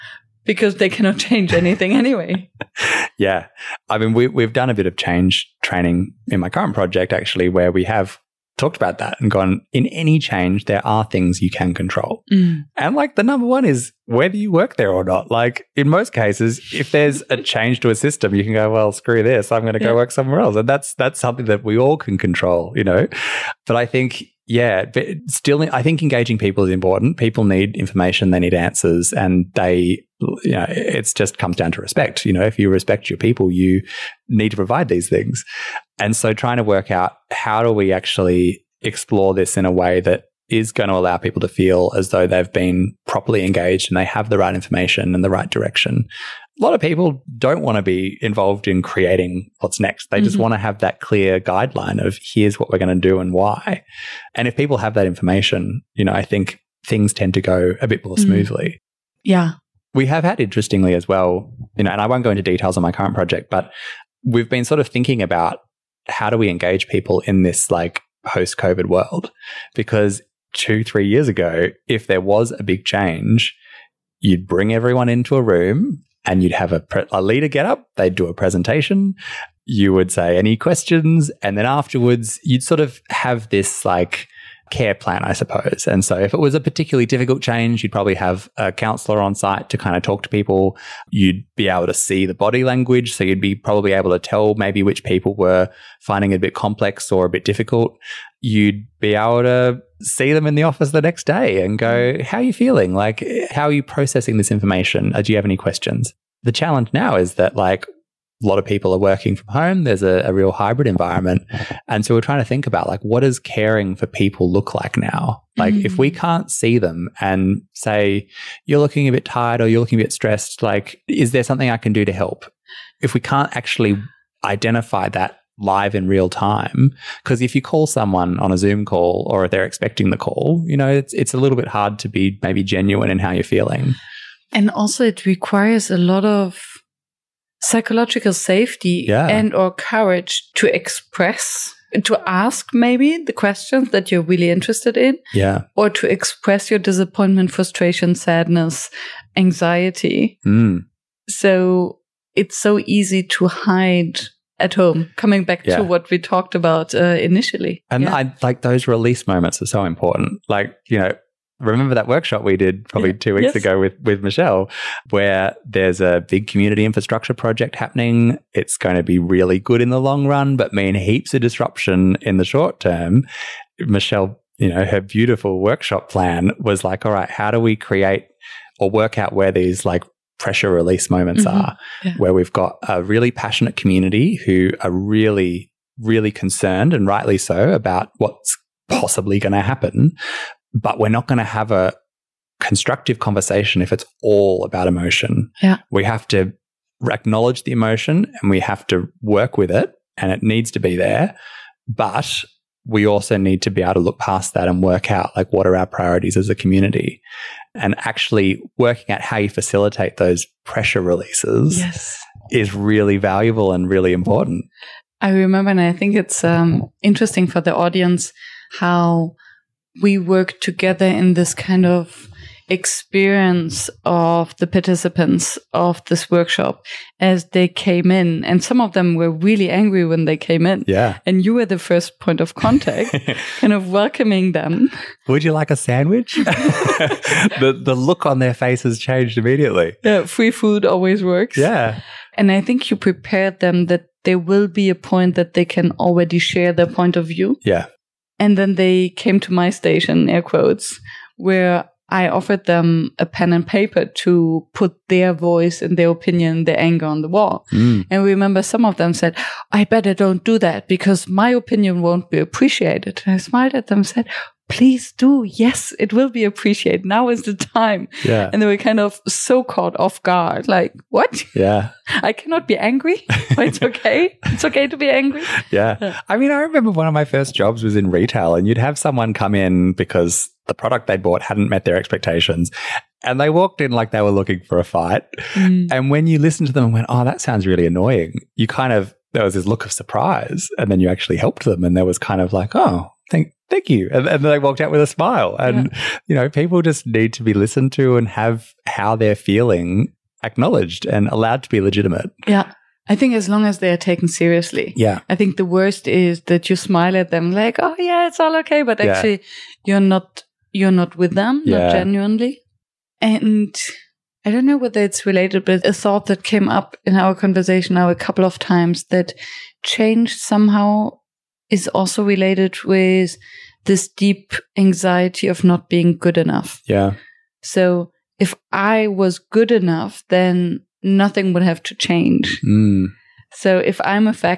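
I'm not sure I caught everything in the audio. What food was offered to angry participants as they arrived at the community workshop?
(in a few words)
A sandwich.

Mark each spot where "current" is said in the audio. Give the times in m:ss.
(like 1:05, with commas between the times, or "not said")
0:06, 1:02.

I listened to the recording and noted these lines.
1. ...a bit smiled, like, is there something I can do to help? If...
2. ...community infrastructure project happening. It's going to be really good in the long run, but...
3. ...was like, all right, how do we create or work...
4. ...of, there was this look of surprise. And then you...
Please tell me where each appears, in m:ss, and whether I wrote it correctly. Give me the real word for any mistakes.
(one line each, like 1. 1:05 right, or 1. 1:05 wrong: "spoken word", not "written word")
1. 2:00 wrong: "stressed", not "smiled"
2. 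2:46 right
3. 2:56 right
4. 4:48 right.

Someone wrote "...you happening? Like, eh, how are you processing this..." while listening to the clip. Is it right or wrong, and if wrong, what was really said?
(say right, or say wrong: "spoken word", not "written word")
wrong: "feeling", not "happening".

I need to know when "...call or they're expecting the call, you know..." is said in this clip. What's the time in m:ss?
2:08.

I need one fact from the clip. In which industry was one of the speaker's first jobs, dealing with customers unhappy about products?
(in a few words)
Retail.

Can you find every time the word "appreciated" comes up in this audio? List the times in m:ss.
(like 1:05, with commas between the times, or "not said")
4:22, 4:26.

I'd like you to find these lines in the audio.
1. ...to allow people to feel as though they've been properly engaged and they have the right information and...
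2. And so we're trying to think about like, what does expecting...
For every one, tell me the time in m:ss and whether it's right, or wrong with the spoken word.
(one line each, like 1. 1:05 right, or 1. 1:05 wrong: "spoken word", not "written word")
1. 0:40 right
2. 1:51 wrong: "caring", not "expecting".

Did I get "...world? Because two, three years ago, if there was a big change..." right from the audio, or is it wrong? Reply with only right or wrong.
right.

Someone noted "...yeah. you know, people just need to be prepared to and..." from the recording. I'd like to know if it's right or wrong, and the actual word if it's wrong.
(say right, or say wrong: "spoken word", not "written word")
wrong: "listened", not "prepared".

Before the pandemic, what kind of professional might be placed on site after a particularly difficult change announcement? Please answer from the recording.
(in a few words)
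A counselor.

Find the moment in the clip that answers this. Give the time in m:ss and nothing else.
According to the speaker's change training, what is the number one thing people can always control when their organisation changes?
0:14.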